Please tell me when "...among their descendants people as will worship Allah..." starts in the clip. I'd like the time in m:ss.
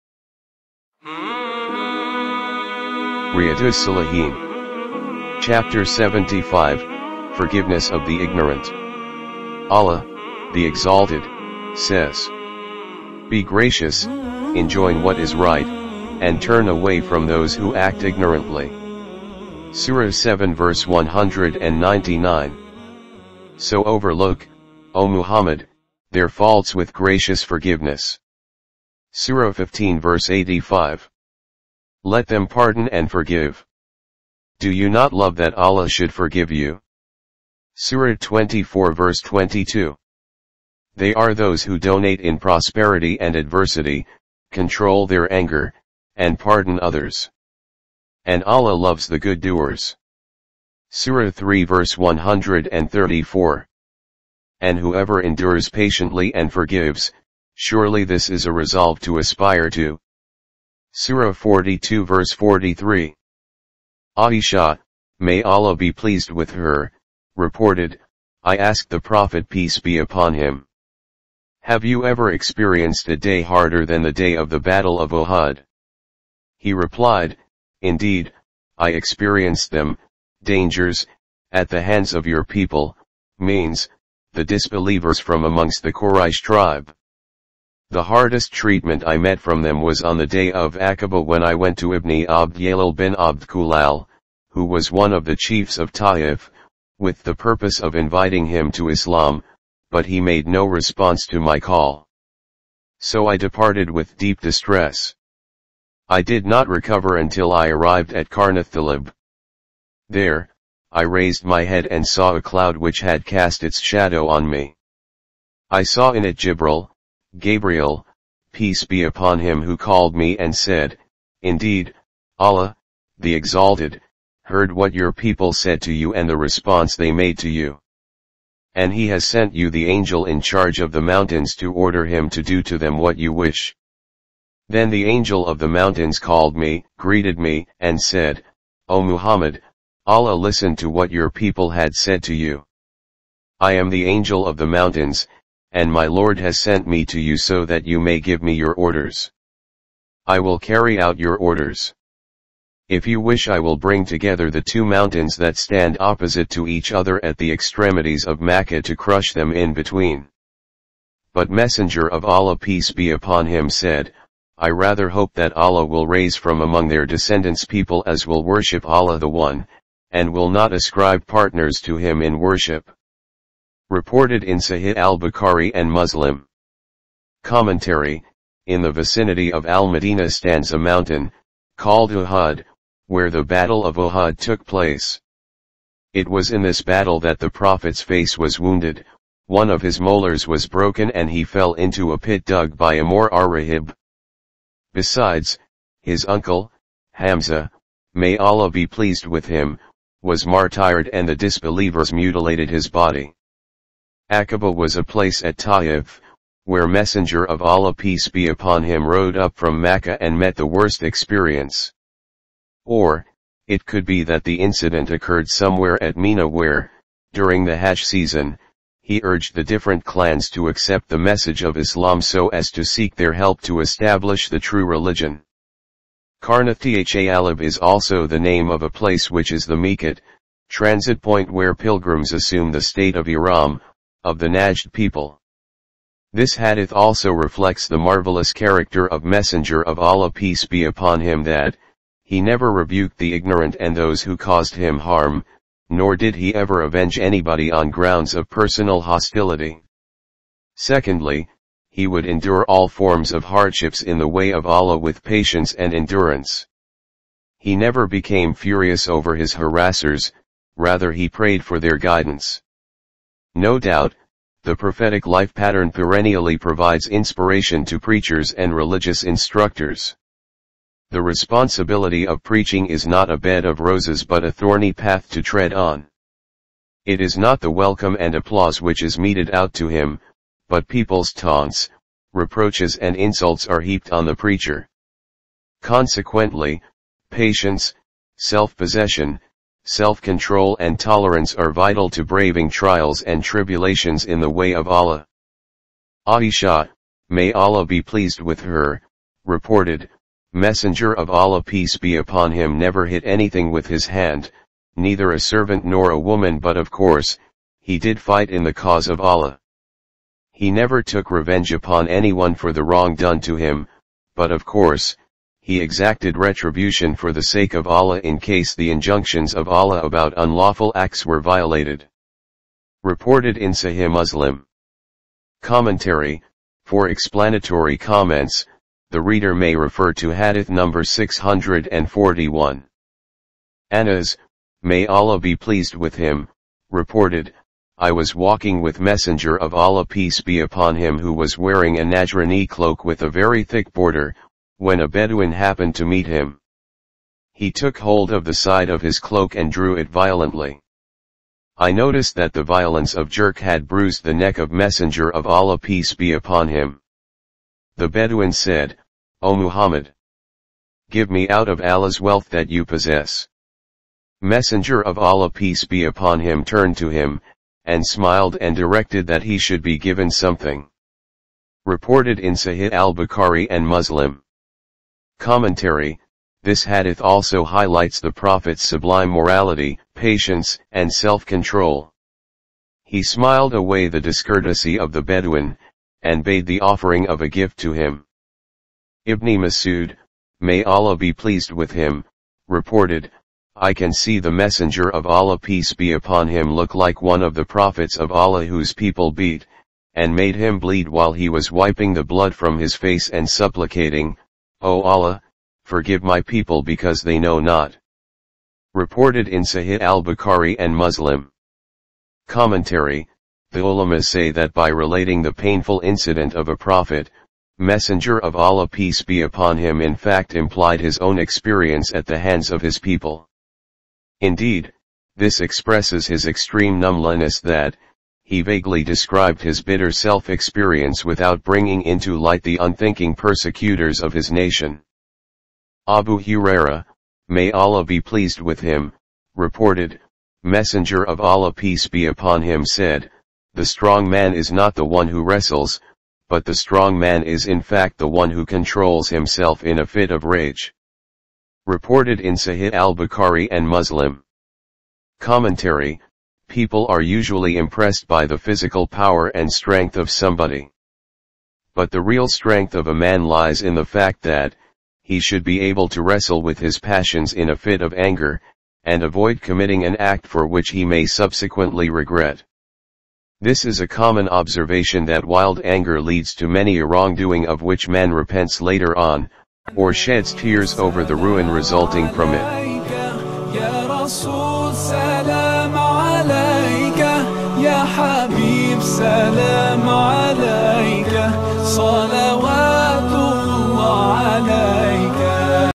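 2:46.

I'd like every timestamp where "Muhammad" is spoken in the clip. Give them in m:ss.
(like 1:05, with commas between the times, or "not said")
0:25, 2:19, 5:59.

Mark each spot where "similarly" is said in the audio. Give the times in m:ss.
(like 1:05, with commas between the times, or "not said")
not said.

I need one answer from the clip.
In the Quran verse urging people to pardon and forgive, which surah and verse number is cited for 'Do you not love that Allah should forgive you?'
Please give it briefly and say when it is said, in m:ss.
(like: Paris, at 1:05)
Surah 24 verse 22, at 0:37.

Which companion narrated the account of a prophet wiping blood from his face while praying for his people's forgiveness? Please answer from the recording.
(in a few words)
Ibn Masud.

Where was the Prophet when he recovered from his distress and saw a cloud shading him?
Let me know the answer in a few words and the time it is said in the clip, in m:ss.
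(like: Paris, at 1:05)
Qarn-ath-Tha'alib, at 1:48.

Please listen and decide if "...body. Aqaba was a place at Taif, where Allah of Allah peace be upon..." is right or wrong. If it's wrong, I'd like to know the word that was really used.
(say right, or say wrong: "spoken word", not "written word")
wrong: "Messenger", not "Allah".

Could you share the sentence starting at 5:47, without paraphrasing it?
He took hold of the side of his cloak and drew it violently.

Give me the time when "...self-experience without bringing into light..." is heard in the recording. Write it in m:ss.
7:10.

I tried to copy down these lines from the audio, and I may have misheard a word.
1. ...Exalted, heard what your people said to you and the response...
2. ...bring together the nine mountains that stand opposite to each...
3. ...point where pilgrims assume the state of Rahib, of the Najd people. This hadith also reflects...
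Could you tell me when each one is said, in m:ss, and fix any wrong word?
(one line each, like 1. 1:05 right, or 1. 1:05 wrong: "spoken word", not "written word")
1. 2:03 right
2. 2:33 wrong: "two", not "nine"
3. 3:51 wrong: "Ihram", not "Rahib".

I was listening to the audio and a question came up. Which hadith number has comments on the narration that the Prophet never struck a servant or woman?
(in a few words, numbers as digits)
641.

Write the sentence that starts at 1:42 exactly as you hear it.
So I departed with deep distress.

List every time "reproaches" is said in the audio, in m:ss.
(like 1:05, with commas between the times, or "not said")
4:42.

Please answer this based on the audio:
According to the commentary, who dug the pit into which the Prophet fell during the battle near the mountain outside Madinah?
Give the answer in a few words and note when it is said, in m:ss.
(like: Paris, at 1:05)
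Amor Rahib, at 3:12.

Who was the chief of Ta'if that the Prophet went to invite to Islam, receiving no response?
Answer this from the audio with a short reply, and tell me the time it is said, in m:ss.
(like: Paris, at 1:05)
Ibn Abd Yalil bin Abd Kulal, at 1:31.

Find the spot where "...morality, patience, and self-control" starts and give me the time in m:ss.
6:19.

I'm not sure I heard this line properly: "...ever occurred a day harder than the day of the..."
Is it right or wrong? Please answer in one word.
wrong.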